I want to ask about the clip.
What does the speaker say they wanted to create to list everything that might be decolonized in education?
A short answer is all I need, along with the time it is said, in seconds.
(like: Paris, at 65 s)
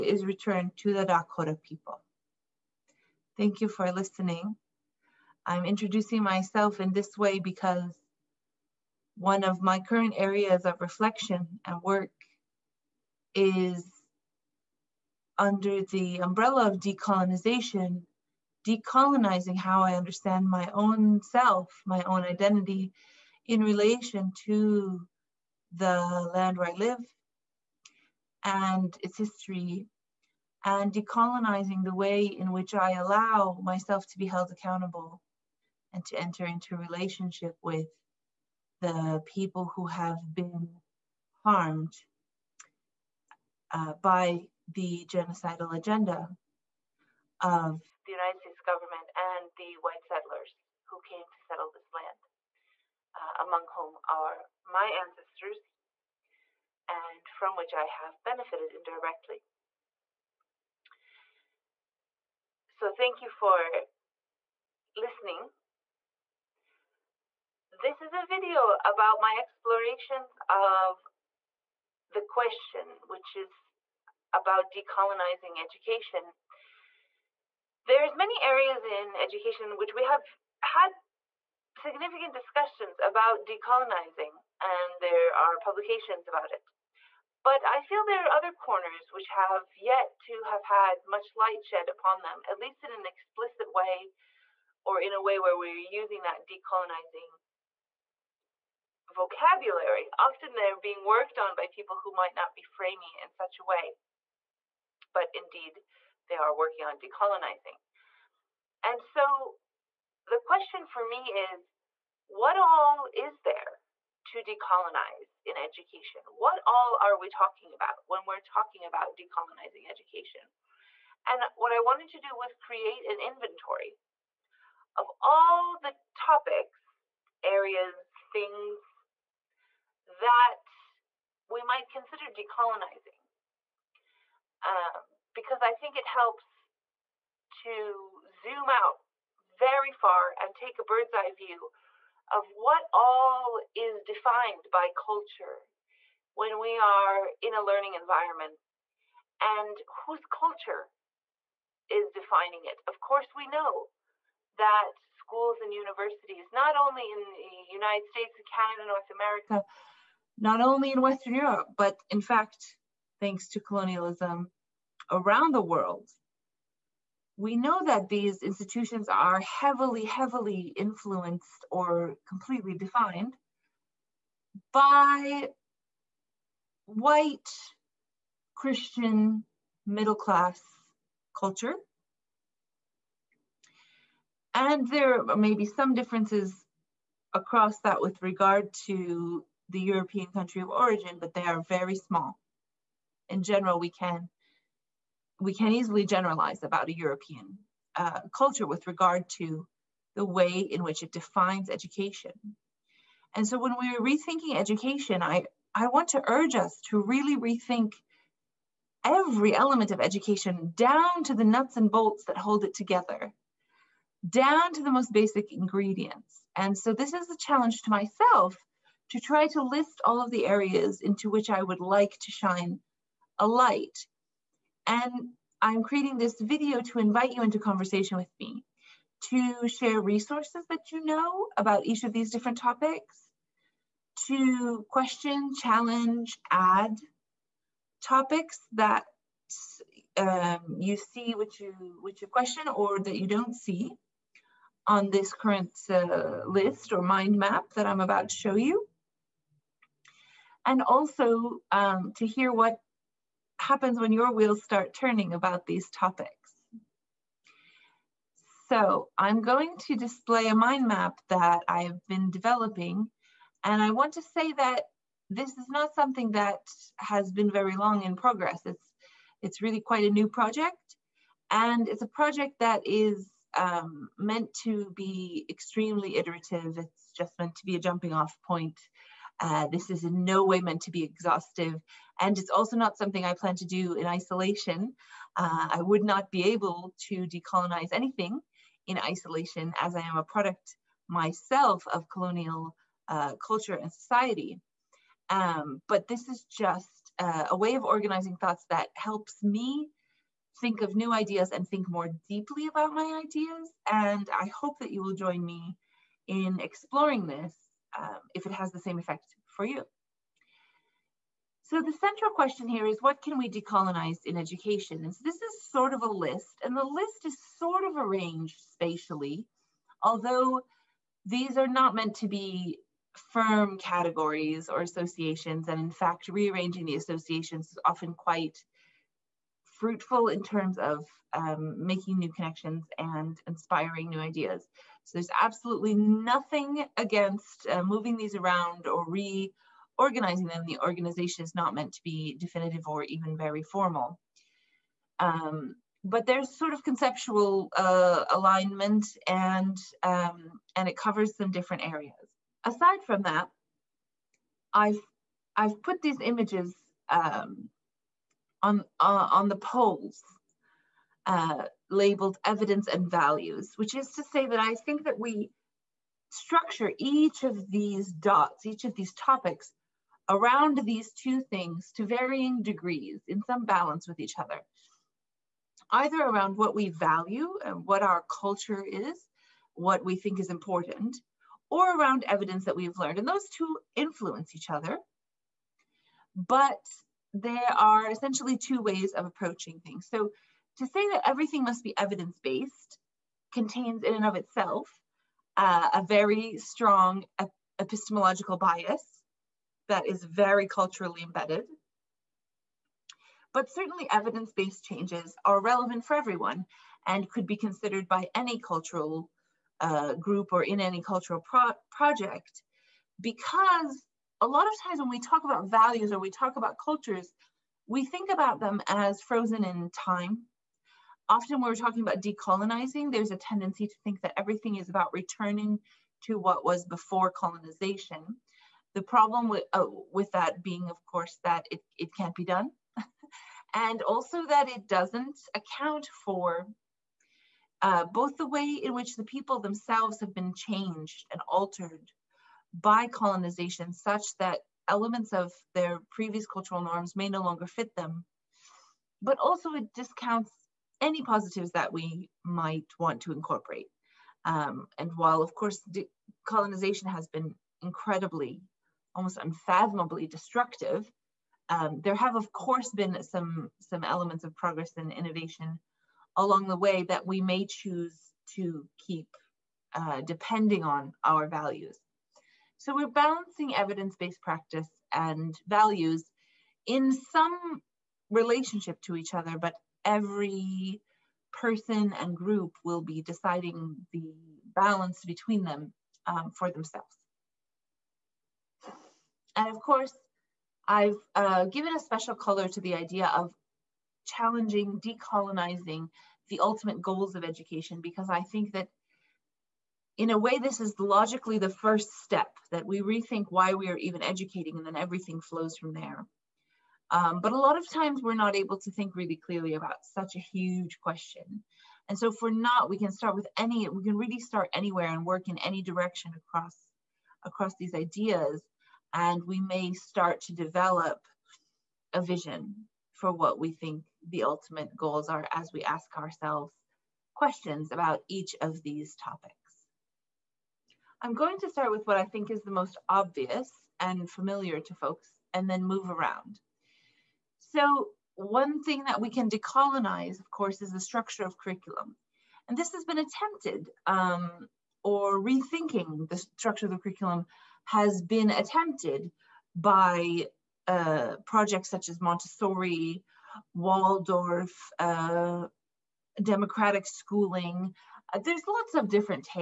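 an inventory, at 123 s.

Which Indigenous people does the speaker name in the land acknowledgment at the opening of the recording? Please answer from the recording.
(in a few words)
Dakota.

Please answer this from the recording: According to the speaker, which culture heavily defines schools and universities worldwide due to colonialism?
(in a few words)
white Christian middle class.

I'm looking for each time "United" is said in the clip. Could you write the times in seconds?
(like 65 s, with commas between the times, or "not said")
48 s, 157 s.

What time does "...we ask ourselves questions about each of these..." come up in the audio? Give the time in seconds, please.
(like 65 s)
525 s.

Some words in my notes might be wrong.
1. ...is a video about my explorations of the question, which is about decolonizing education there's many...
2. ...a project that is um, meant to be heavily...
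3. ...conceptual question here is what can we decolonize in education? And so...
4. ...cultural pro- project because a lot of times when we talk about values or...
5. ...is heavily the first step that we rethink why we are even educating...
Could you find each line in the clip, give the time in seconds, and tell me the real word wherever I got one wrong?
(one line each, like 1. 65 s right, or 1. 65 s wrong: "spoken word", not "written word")
1. 68 s right
2. 272 s wrong: "extremely", not "heavily"
3. 312 s wrong: "central", not "conceptual"
4. 411 s right
5. 500 s wrong: "logically", not "heavily".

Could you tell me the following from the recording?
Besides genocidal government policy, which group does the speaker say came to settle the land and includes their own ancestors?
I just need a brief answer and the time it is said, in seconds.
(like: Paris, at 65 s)
white settlers, at 49 s.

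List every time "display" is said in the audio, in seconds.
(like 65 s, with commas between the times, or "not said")
259 s.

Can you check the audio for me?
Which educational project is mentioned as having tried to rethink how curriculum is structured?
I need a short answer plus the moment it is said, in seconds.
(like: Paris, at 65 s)
Montessori, at 552 s.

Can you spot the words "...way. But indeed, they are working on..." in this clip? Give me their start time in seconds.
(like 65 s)
103 s.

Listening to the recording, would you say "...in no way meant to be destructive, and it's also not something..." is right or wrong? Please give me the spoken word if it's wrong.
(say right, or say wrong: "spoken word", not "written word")
wrong: "exhaustive", not "destructive".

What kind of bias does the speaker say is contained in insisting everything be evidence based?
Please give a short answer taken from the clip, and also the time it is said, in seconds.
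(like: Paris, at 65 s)
epistemological bias, at 397 s.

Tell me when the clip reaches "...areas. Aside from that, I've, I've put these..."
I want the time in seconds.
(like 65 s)
351 s.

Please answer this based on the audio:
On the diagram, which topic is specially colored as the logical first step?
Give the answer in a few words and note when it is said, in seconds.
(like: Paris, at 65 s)
ultimate goals of education, at 496 s.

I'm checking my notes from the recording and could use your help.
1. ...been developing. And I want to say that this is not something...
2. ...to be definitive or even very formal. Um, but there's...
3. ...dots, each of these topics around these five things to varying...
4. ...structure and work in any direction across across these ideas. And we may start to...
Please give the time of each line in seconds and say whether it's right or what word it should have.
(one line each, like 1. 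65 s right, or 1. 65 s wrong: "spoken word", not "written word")
1. 262 s right
2. 341 s right
3. 368 s wrong: "two", not "five"
4. 514 s wrong: "anywhere", not "structure".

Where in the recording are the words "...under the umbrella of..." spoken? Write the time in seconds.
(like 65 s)
15 s.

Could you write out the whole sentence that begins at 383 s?
And those two influence each other, but there are essentially two ways of approaching things.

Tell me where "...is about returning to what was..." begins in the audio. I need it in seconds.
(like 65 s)
424 s.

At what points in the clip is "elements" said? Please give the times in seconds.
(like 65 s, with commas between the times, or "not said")
209 s, 444 s, 464 s.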